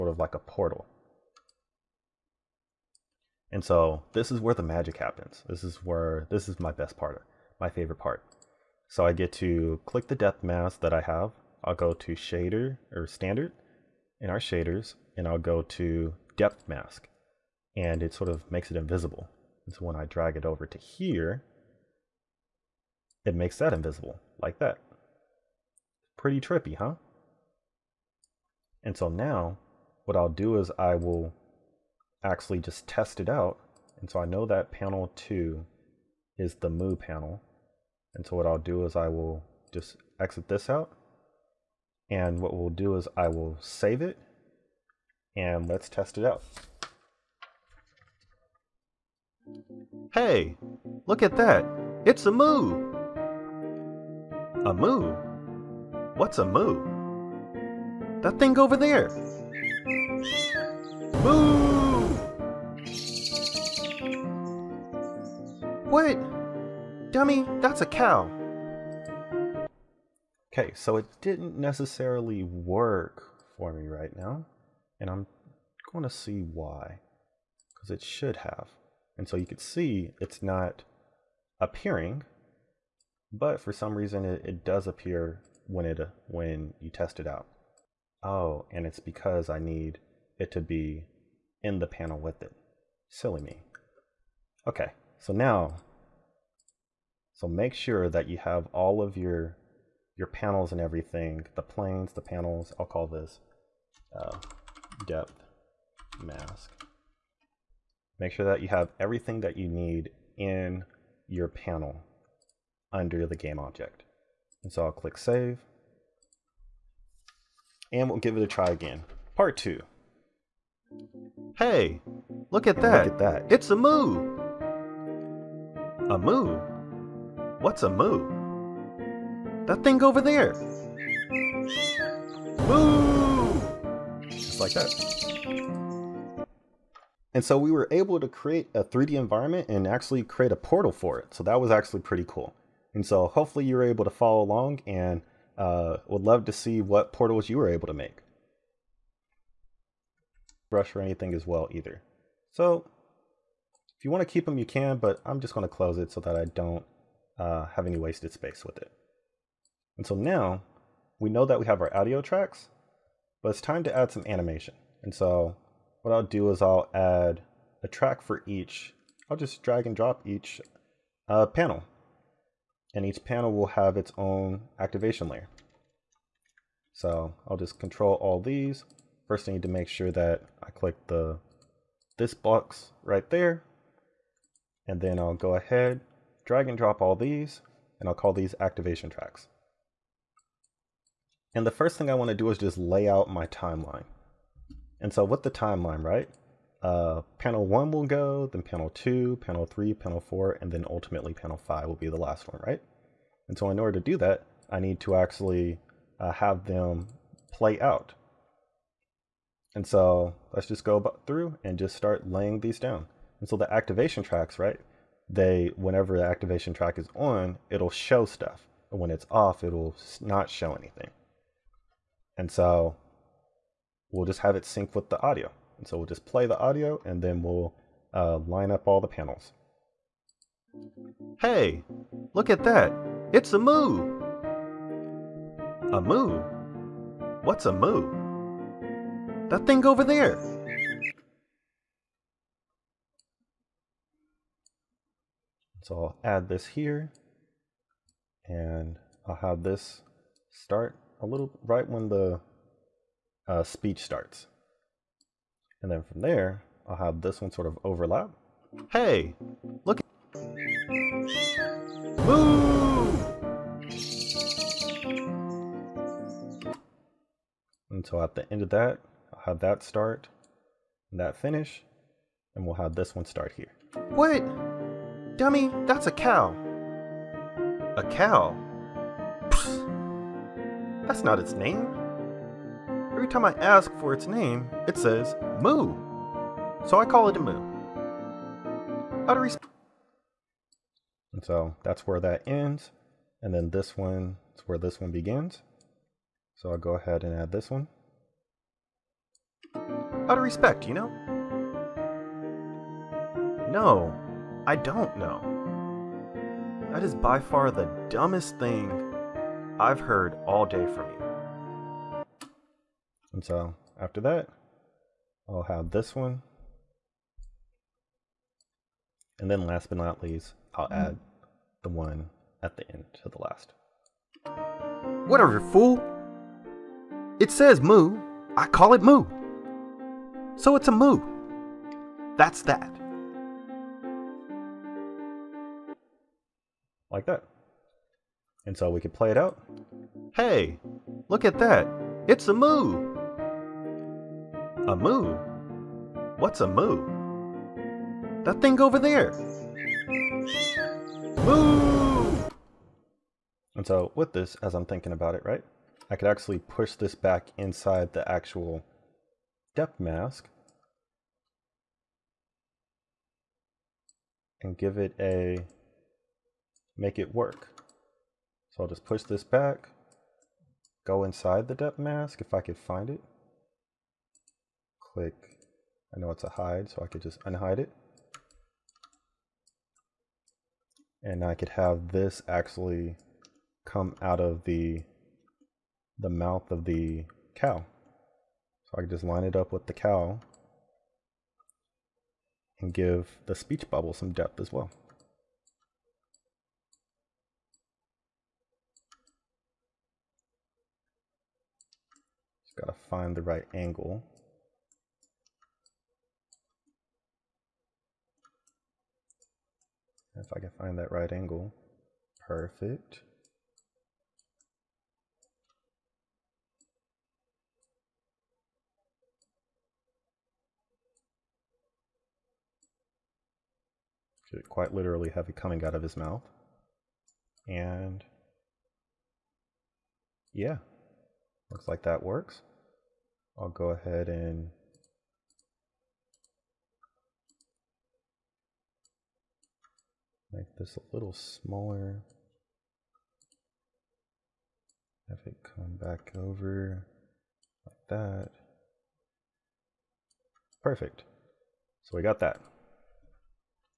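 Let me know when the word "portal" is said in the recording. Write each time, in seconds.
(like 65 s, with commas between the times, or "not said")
0 s, 140 s, 147 s.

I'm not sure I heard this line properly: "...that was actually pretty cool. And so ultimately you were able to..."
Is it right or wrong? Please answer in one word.
wrong.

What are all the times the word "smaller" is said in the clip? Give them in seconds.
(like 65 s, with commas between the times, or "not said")
441 s.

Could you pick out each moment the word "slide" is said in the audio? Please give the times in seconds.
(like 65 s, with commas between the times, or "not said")
not said.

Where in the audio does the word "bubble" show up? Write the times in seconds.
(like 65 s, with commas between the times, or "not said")
393 s.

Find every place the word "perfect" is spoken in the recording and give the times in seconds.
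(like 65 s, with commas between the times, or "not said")
412 s, 450 s.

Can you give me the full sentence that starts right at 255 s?
And then from there, I'll have this one sort of overlap.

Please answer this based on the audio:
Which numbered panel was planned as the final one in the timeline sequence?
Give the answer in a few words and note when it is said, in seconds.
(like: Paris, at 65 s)
panel five, at 201 s.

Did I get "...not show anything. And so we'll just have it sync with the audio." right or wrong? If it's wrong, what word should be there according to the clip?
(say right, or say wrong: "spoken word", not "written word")
right.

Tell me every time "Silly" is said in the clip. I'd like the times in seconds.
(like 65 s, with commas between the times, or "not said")
93 s.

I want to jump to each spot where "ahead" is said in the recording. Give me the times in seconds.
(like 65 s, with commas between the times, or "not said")
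185 s, 296 s, 433 s.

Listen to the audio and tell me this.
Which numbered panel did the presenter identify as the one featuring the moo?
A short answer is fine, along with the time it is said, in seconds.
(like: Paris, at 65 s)
panel 2, at 34 s.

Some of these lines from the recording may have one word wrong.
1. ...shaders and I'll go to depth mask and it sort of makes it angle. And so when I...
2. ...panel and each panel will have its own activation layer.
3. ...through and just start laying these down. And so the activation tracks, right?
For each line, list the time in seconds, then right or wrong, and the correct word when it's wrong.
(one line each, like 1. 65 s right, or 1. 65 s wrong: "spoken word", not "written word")
1. 14 s wrong: "invisible", not "angle"
2. 171 s right
3. 211 s right.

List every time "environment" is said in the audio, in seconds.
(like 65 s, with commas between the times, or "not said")
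139 s.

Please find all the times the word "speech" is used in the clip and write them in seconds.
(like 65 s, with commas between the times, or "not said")
253 s, 393 s.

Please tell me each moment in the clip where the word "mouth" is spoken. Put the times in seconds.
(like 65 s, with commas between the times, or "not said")
386 s, 426 s.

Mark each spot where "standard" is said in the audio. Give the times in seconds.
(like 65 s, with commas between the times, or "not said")
13 s.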